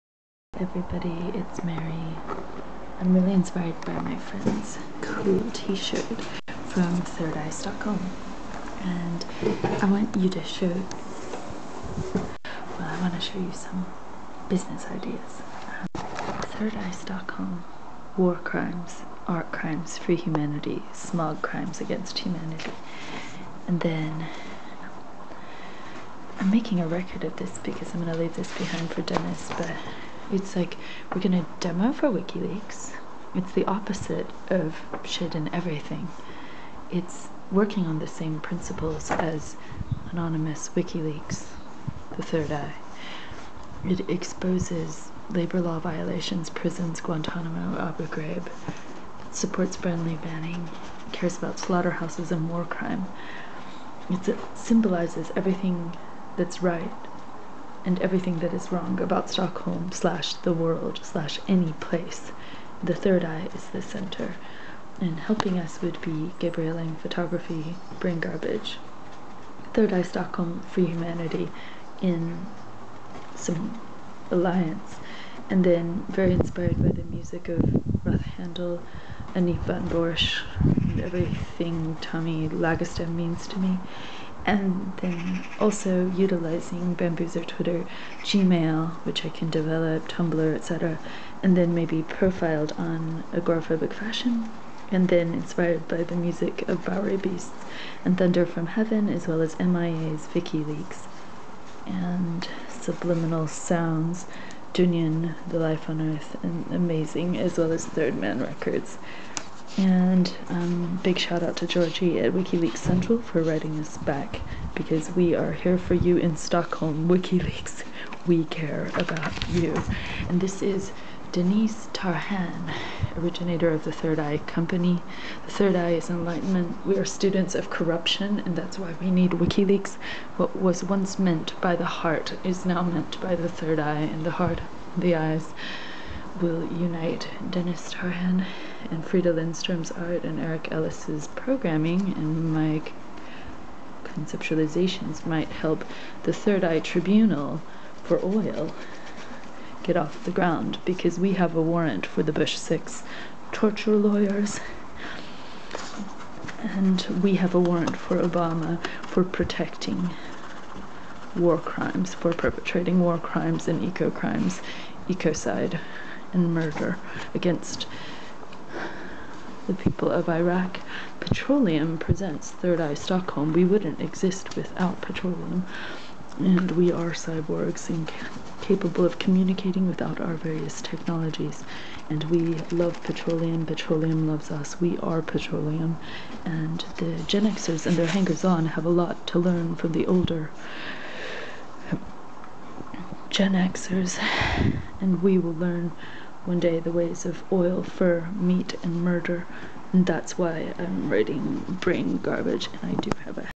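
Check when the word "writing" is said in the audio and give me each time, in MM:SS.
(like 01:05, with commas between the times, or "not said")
01:53, 03:21.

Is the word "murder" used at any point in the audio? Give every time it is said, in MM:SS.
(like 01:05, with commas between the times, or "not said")
02:46, 03:19.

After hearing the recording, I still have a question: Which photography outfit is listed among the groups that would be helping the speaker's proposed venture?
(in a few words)
Gabriel Lang Photography.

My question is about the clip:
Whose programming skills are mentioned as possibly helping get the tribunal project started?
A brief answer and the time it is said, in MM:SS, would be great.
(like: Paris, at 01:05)
Eric Ellis, at 02:20.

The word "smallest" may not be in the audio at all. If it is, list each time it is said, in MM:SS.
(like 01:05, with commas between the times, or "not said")
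not said.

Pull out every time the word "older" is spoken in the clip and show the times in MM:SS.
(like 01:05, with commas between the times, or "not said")
03:10.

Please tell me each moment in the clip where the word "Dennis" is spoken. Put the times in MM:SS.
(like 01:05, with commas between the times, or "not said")
00:29.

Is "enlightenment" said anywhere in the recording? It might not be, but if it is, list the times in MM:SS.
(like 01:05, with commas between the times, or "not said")
02:06.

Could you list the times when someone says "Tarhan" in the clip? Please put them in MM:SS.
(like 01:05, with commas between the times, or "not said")
02:01, 02:17.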